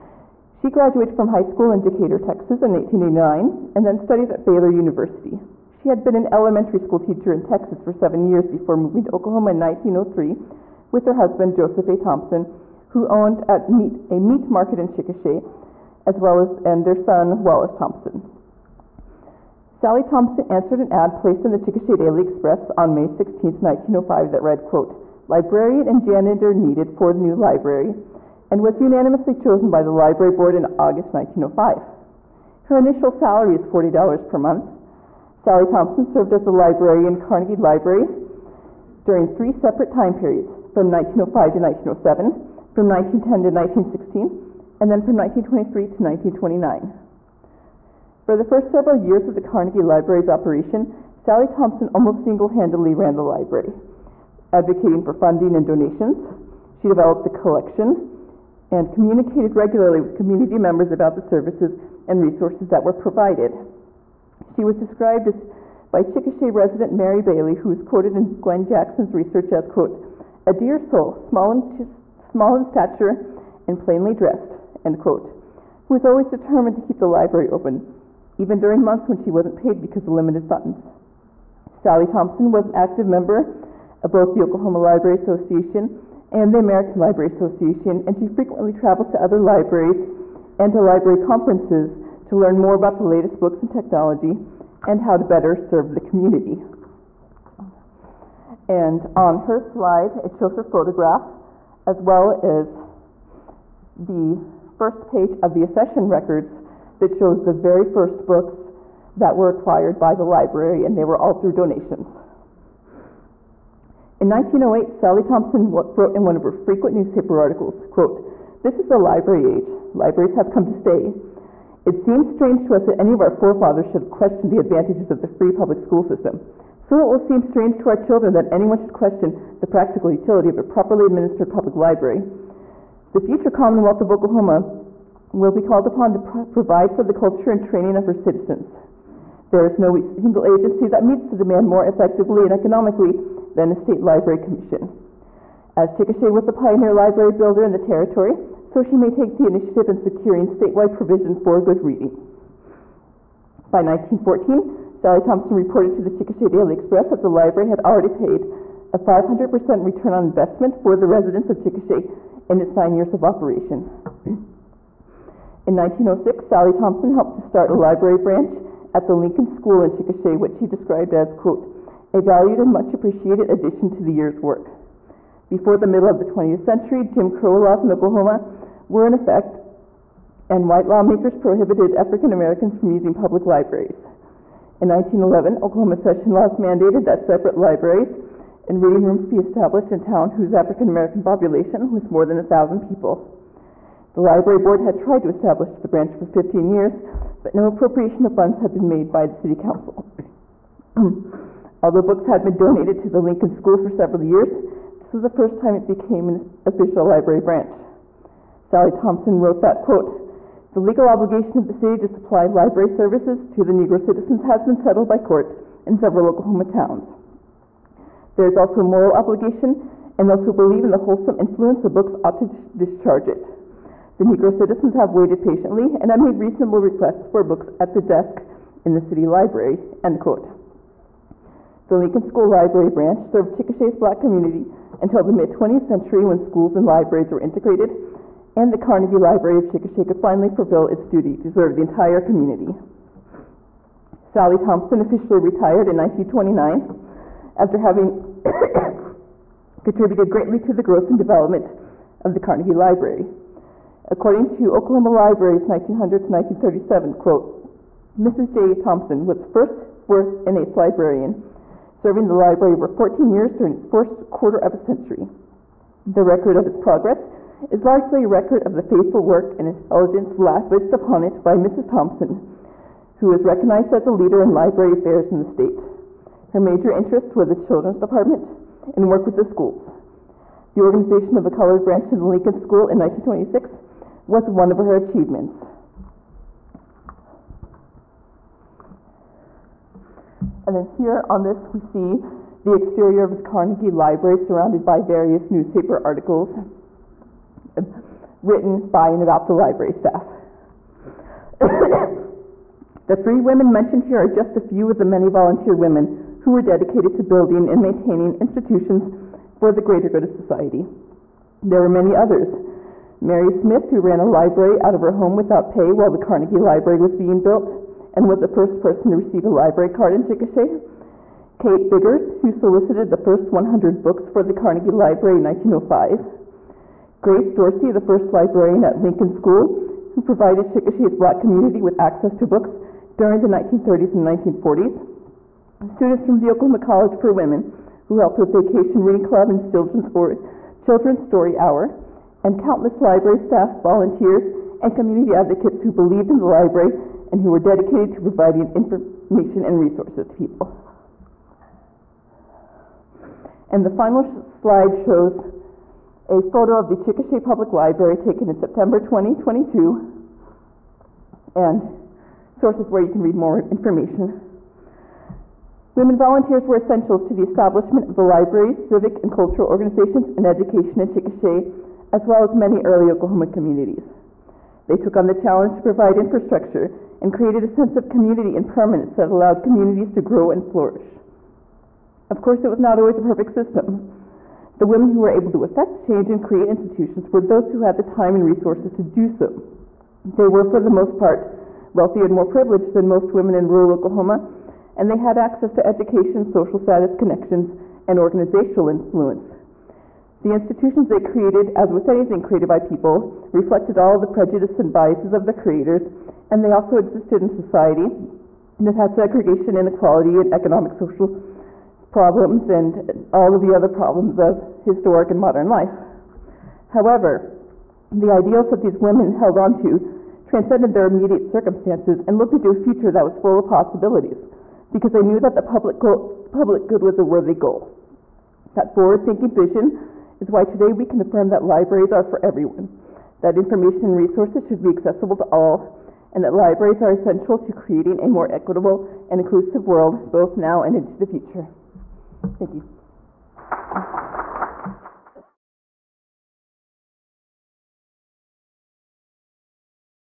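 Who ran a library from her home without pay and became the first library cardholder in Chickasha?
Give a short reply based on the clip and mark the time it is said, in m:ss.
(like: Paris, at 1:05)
Mary Smith, at 5:13.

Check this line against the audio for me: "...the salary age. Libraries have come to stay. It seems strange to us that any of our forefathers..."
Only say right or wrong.
wrong.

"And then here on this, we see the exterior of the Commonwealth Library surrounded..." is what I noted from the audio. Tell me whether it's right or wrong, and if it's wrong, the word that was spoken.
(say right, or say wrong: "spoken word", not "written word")
wrong: "Carnegie", not "Commonwealth".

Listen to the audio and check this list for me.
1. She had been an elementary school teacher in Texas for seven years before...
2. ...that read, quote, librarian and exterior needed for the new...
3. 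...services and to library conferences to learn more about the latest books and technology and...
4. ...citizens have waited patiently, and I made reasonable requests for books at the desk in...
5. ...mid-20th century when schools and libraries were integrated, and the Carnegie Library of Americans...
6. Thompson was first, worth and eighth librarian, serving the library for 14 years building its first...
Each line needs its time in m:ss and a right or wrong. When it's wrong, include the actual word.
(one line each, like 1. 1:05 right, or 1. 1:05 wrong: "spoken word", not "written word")
1. 0:05 right
2. 0:24 wrong: "janitor", not "exterior"
3. 1:29 wrong: "libraries", not "services"
4. 3:44 right
5. 3:55 wrong: "Chickasha", not "Americans"
6. 4:18 wrong: "during", not "building".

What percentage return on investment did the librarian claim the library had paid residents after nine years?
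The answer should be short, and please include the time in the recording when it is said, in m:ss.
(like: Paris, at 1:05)
500%, at 2:38.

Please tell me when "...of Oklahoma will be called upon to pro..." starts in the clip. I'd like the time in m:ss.
2:14.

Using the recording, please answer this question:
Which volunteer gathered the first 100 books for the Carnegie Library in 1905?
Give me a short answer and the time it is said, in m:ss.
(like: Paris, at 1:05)
Kate Biggers, at 5:21.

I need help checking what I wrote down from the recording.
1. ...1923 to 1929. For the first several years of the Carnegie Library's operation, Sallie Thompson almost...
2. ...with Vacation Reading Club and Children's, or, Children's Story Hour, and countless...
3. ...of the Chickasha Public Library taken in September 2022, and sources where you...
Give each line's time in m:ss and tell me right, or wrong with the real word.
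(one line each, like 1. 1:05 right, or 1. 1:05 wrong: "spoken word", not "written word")
1. 0:45 right
2. 5:38 right
3. 5:56 right.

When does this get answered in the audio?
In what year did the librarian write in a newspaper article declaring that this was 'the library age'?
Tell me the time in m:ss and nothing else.
1:54.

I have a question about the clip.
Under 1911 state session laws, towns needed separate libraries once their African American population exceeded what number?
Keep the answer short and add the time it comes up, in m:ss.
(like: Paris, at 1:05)
1,000, at 3:12.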